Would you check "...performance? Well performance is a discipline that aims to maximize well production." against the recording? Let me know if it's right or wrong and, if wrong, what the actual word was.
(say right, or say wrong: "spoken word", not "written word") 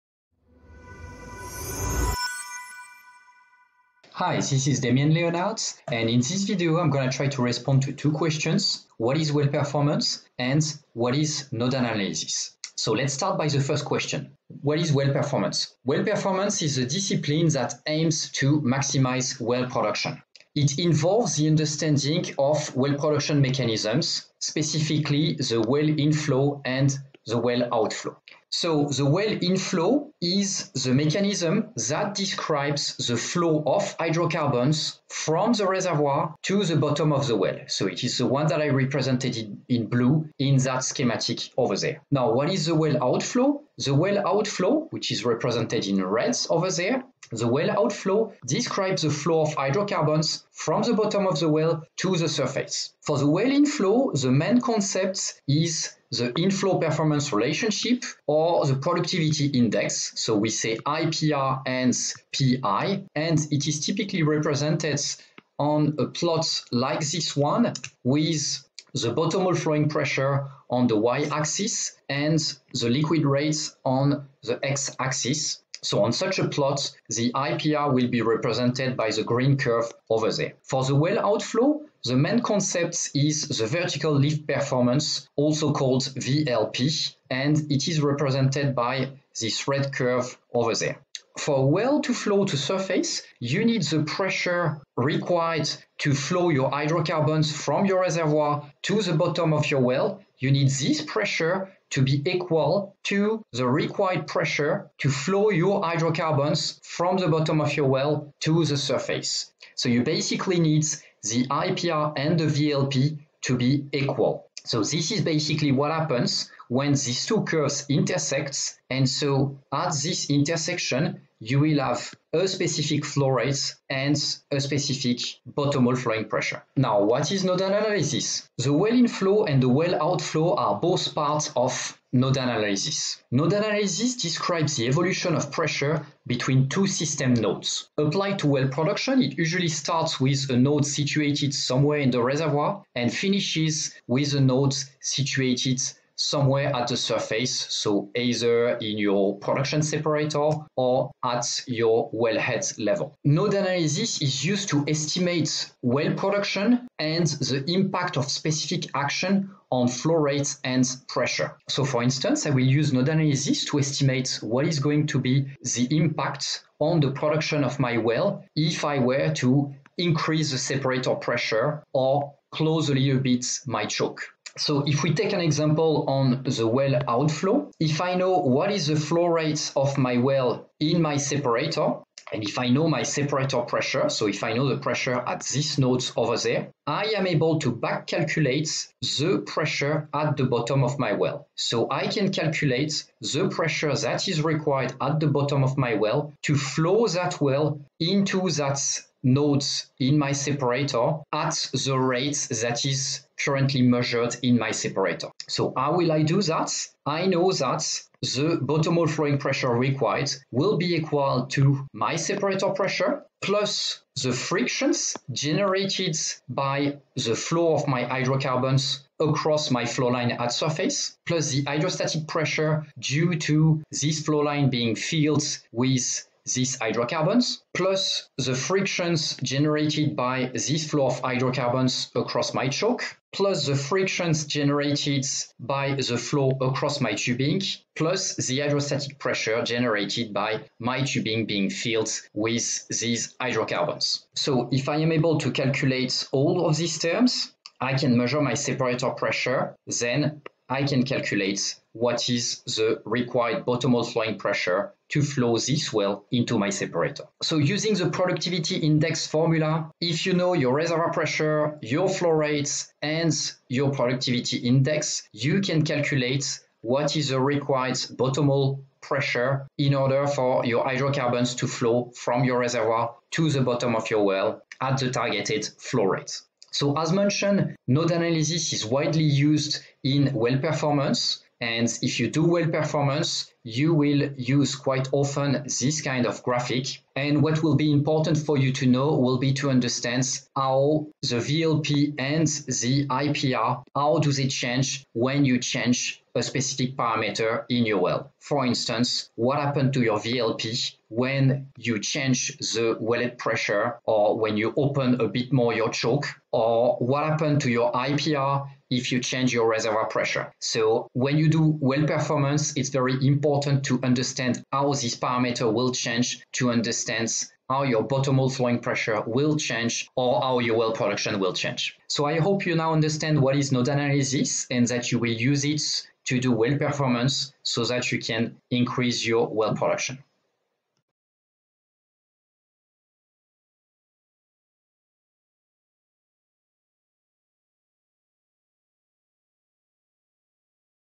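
right.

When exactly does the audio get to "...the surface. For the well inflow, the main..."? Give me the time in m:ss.
0:52.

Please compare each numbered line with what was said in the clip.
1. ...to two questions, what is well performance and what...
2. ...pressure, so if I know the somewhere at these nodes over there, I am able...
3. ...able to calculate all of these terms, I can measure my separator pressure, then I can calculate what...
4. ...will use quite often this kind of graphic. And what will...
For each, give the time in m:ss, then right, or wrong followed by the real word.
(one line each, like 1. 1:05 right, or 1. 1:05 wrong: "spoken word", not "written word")
1. 0:07 right
2. 3:03 wrong: "pressure", not "somewhere"
3. 4:05 right
4. 4:43 right.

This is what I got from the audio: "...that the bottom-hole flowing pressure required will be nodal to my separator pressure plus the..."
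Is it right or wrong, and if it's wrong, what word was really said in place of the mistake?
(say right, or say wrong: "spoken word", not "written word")
wrong: "equal", not "nodal".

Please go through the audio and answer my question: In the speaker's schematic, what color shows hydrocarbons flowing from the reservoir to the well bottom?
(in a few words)
Blue.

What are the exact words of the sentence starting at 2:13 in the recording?
Nodal analysis describes the evolution of pressure between two system nodes.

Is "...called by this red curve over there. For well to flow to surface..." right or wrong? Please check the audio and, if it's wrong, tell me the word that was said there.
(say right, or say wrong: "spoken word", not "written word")
wrong: "represented", not "called".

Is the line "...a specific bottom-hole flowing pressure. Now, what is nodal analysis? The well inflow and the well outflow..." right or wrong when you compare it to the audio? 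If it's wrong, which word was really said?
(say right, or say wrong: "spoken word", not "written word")
right.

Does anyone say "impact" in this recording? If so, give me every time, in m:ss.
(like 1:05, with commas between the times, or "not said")
2:37, 2:45.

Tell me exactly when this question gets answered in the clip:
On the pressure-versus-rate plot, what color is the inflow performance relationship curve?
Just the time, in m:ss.
1:19.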